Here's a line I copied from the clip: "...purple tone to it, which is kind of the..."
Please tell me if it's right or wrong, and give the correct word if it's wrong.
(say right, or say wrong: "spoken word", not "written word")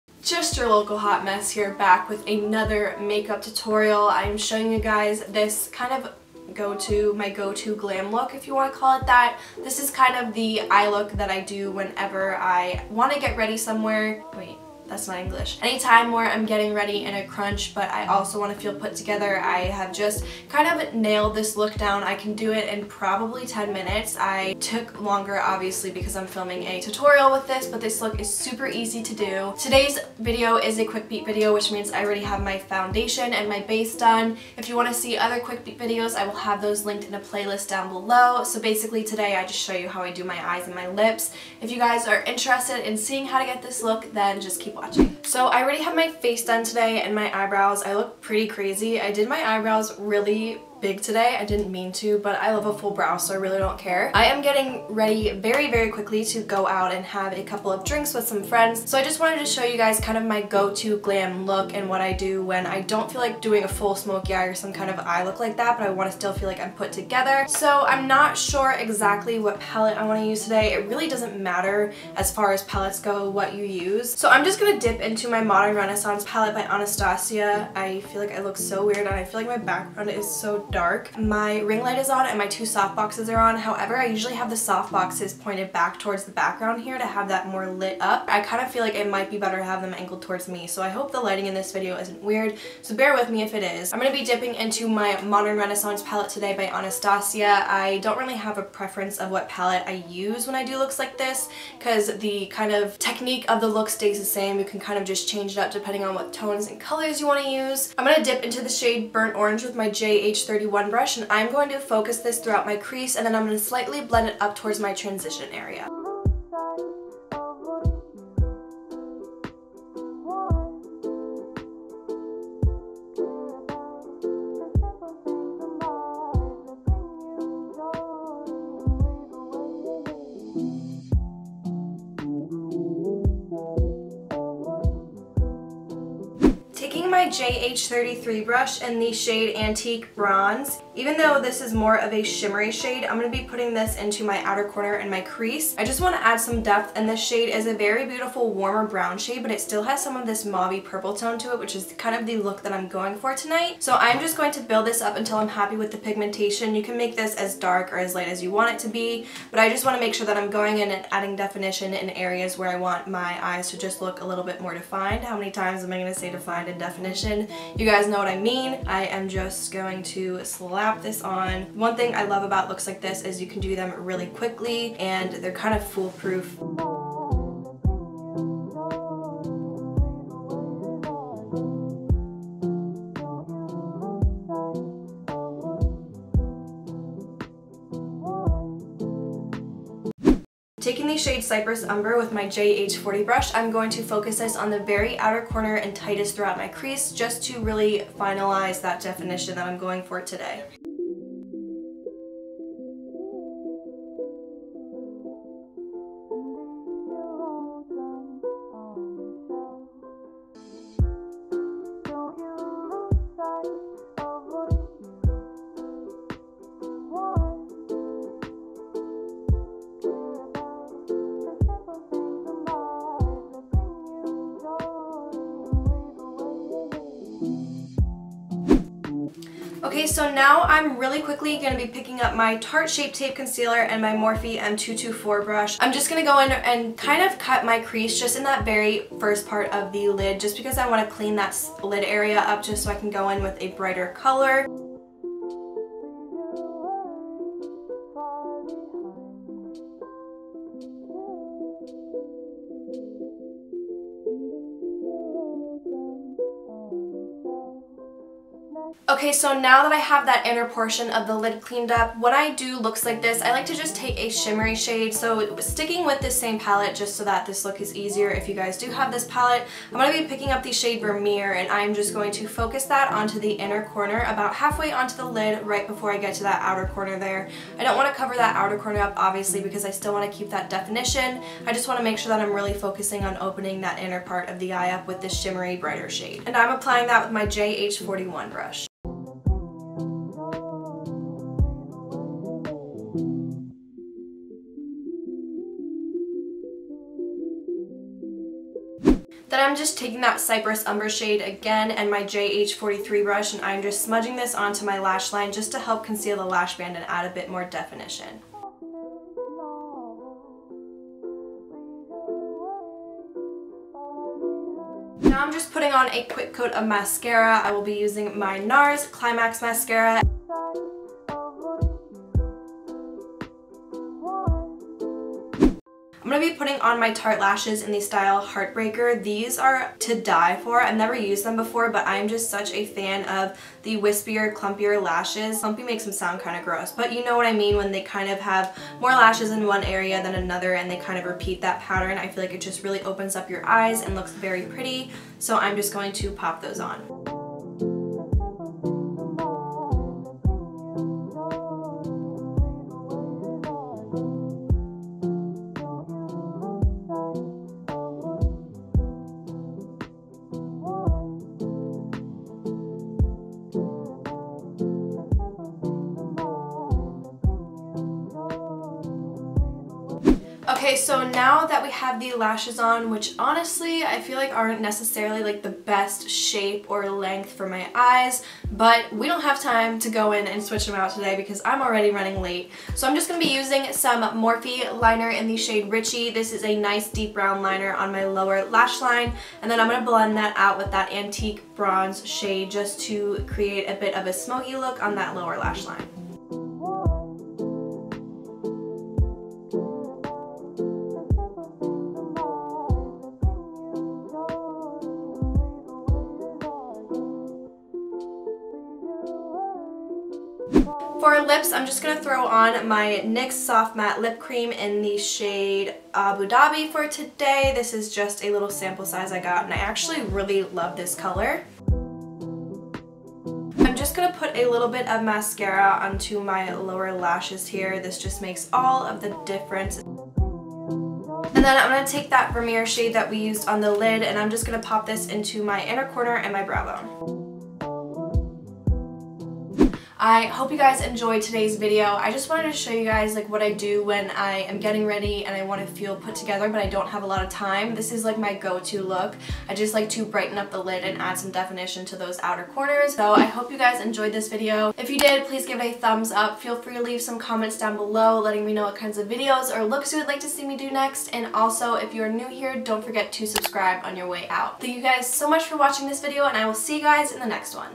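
right.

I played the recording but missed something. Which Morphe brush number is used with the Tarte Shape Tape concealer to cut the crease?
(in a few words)
M224.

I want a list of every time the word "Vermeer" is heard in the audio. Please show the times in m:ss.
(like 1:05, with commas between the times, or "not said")
4:31, 7:12.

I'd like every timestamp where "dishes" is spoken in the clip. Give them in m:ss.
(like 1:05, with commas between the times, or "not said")
not said.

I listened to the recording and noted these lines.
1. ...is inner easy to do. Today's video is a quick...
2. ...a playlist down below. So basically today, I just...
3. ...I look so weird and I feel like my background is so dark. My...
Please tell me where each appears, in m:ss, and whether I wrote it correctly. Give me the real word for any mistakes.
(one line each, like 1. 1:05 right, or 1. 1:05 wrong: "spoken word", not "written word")
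1. 0:28 wrong: "super", not "inner"
2. 0:37 right
3. 1:18 right.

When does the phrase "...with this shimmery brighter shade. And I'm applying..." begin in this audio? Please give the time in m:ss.
4:45.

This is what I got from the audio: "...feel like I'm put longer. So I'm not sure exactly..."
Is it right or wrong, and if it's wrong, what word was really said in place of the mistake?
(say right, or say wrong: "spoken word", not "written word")
wrong: "together", not "longer".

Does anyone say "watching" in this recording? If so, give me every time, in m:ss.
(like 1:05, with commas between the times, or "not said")
0:44, 7:45.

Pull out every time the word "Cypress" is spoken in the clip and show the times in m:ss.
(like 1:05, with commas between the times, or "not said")
3:11, 5:00.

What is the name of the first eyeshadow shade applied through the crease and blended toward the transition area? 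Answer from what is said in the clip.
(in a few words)
Burnt Orange.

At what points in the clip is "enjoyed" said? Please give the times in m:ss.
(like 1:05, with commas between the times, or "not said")
7:21, 7:33.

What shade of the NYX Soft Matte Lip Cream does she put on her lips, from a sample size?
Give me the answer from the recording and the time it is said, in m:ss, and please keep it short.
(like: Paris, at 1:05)
Abu Dhabi, at 6:56.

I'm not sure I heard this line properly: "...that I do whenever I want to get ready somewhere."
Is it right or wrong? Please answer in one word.
right.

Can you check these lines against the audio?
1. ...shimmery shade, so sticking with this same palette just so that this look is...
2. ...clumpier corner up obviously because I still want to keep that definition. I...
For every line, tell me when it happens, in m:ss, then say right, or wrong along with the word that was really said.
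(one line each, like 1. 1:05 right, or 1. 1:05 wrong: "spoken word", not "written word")
1. 4:24 right
2. 4:38 wrong: "outer", not "clumpier".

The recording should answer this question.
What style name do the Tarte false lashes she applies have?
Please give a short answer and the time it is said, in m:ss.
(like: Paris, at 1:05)
Heartbreaker, at 5:28.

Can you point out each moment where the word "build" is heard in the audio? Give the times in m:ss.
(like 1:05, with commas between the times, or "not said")
2:34.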